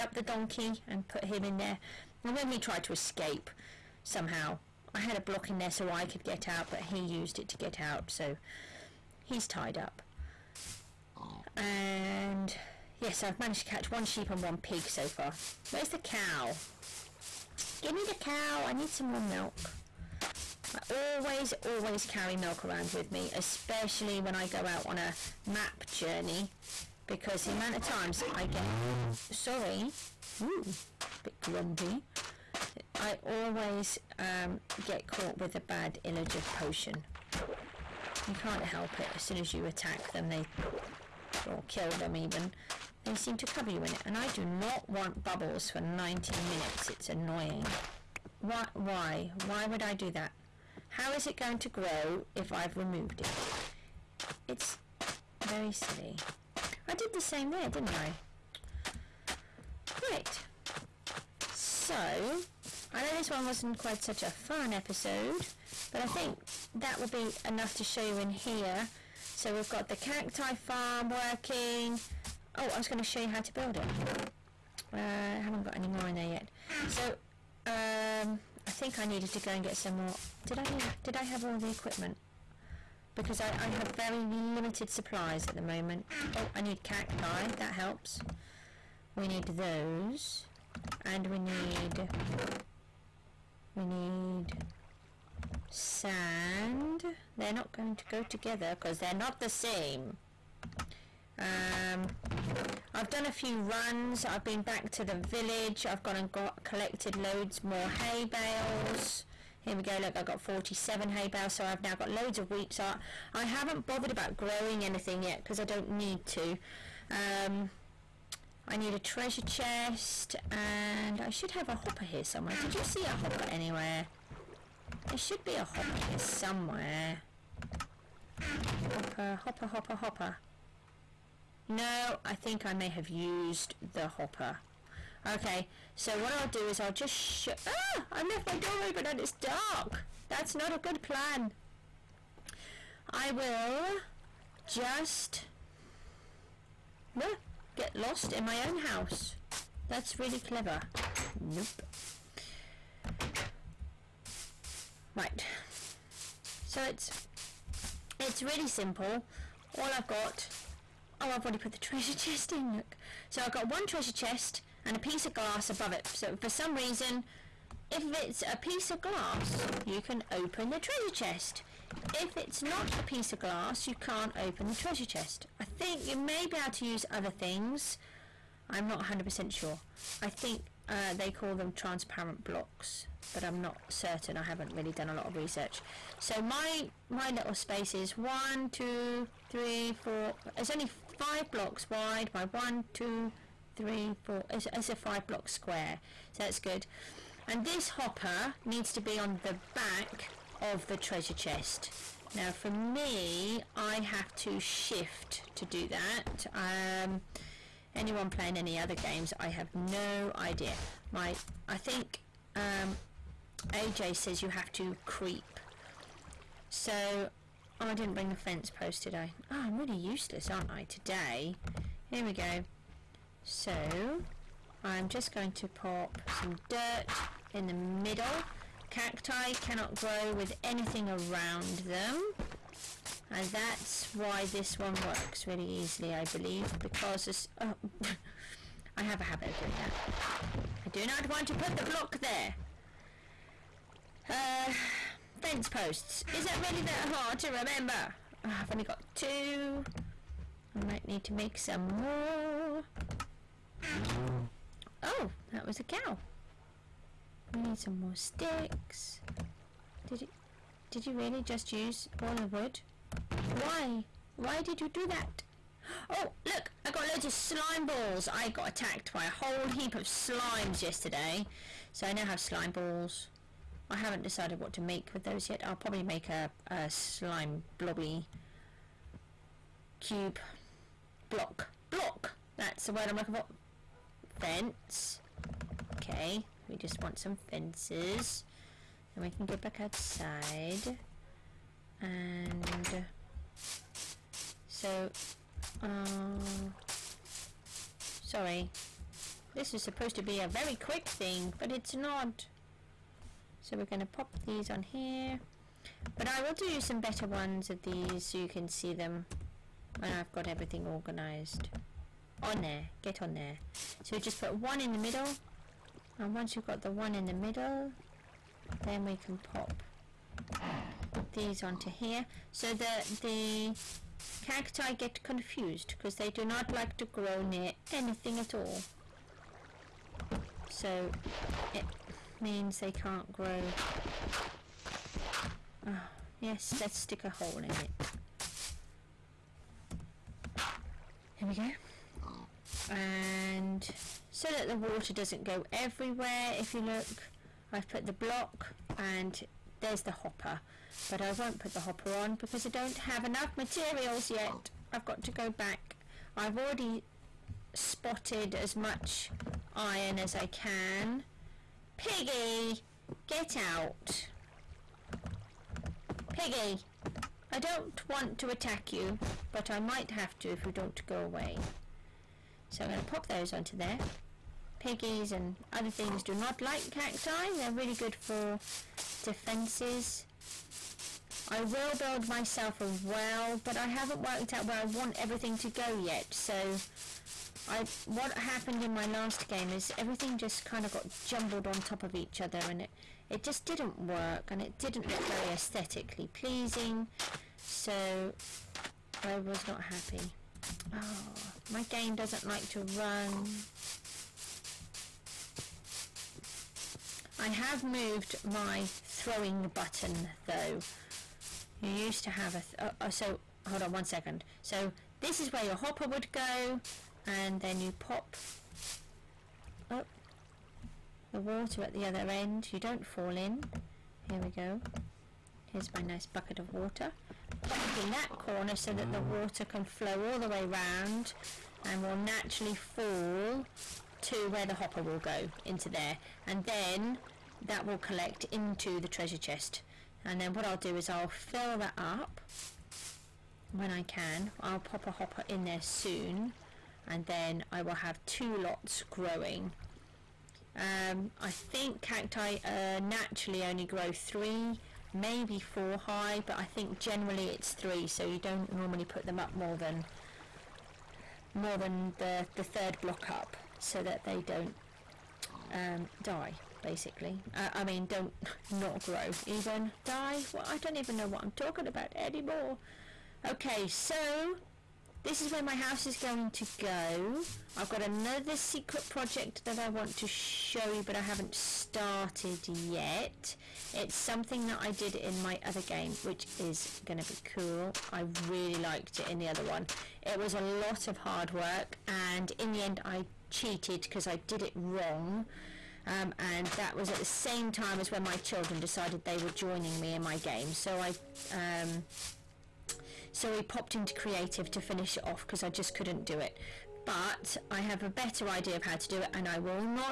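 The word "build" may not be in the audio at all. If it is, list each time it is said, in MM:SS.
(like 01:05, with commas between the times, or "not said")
01:13, 06:21.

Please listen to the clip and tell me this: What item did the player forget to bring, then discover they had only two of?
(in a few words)
Fence posts.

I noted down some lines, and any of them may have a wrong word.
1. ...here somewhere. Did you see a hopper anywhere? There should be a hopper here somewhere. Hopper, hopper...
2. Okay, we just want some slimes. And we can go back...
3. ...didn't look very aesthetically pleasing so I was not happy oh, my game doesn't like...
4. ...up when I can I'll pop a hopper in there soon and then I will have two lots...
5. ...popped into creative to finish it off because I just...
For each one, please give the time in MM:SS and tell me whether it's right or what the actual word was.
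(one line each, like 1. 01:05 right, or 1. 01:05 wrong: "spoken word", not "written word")
1. 02:02 right
2. 04:45 wrong: "fences", not "slimes"
3. 06:34 right
4. 07:21 right
5. 08:23 right.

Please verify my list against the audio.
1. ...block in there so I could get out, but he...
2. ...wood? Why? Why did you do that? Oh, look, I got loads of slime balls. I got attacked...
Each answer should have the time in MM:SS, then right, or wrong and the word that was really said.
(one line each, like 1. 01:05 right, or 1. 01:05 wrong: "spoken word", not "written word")
1. 00:05 right
2. 04:22 right.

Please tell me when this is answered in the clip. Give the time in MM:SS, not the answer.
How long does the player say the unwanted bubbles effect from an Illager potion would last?
00:45.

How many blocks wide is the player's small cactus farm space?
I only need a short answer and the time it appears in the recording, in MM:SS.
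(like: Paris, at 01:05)
5, at 03:11.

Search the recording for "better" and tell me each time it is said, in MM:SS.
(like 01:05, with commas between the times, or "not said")
05:06, 08:28.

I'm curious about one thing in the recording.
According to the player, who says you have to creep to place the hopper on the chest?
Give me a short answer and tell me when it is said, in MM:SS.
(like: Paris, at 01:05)
AJ, at 03:33.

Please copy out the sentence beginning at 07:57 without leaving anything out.
I've got another secret project that I want to show you, but I haven't started yet.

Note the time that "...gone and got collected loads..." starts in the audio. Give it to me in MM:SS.
01:46.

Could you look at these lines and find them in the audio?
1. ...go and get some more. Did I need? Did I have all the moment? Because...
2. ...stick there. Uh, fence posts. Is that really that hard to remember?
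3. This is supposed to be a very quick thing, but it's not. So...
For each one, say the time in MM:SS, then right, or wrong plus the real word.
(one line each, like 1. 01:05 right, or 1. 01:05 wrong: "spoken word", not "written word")
1. 01:19 wrong: "equipment", not "moment"
2. 04:01 wrong: "block", not "stick"
3. 04:59 right.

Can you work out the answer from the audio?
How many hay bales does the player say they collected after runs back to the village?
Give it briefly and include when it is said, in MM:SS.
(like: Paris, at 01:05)
47, at 01:50.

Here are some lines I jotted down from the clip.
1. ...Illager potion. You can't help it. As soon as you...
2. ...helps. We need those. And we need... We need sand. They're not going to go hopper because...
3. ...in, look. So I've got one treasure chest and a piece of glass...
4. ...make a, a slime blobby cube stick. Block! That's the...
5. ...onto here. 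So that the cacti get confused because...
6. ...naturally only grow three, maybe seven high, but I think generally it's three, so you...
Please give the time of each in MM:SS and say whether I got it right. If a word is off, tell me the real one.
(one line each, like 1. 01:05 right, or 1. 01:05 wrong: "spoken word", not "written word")
1. 00:36 right
2. 01:27 wrong: "together", not "hopper"
3. 02:42 right
4. 04:36 wrong: "block", not "stick"
5. 05:21 right
6. 07:33 wrong: "four", not "seven".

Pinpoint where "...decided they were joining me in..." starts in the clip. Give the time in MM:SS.
08:18.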